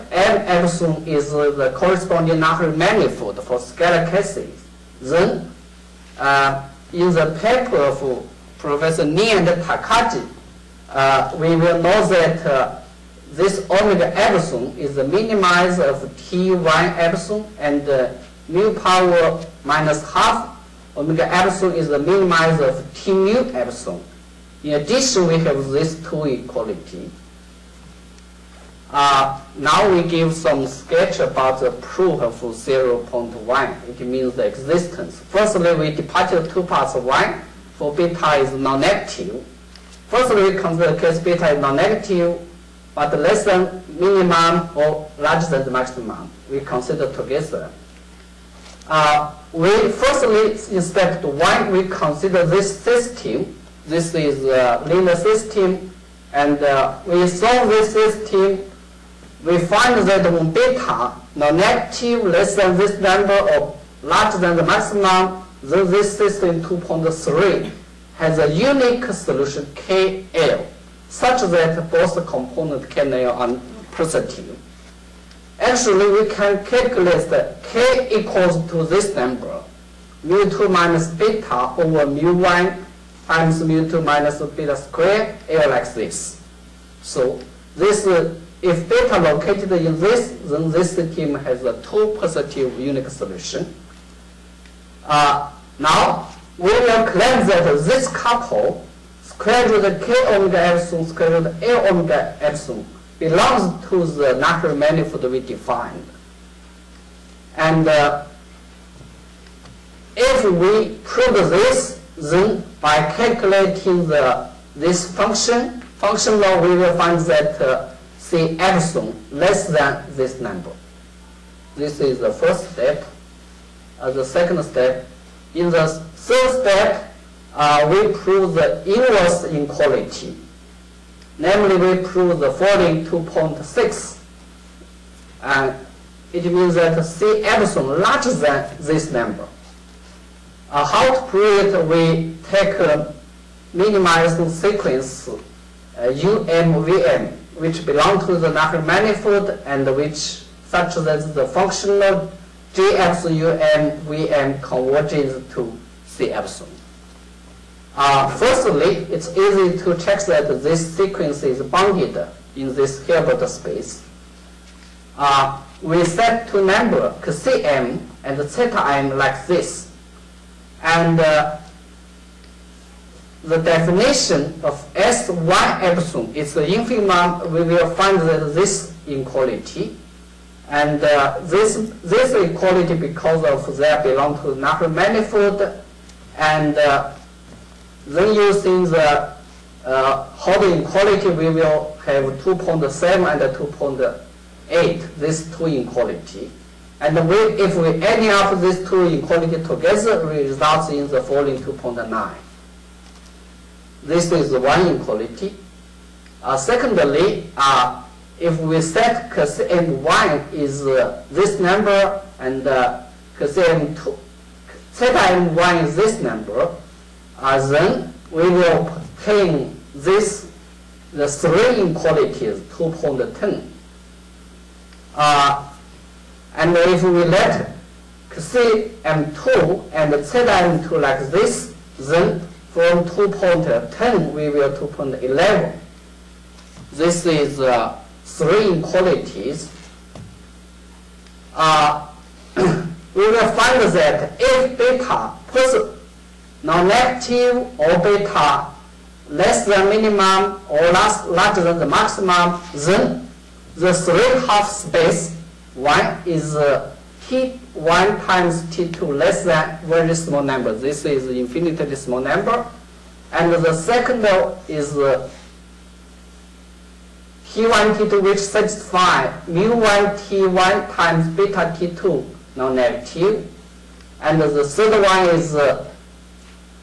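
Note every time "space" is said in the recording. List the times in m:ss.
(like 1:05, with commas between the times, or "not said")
2:43, 4:14.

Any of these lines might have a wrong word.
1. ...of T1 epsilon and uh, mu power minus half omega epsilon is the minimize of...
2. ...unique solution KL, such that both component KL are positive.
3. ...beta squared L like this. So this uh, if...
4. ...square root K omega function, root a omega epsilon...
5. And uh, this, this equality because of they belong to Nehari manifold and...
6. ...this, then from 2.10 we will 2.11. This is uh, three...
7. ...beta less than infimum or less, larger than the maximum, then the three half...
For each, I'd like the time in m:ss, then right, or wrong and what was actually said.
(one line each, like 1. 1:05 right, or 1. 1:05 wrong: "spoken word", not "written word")
1. 0:15 right
2. 1:08 right
3. 1:24 right
4. 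1:39 wrong: "epsilon", not "function"
5. 3:00 right
6. 3:51 right
7. 4:07 wrong: "minimum", not "infimum".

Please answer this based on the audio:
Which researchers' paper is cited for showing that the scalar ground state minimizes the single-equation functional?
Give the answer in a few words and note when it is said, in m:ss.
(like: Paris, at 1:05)
Ni and Takagi, at 0:08.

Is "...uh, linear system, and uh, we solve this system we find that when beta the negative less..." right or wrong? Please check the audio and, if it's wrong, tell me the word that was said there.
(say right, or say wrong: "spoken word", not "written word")
right.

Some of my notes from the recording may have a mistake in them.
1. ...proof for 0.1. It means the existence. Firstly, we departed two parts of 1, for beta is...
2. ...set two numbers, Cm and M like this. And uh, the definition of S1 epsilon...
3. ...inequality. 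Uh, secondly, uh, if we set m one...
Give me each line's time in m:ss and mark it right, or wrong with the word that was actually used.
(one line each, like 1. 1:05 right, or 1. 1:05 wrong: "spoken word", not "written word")
1. 0:31 right
2. 2:46 right
3. 3:24 right.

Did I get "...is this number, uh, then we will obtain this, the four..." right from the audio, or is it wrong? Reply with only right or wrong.
wrong.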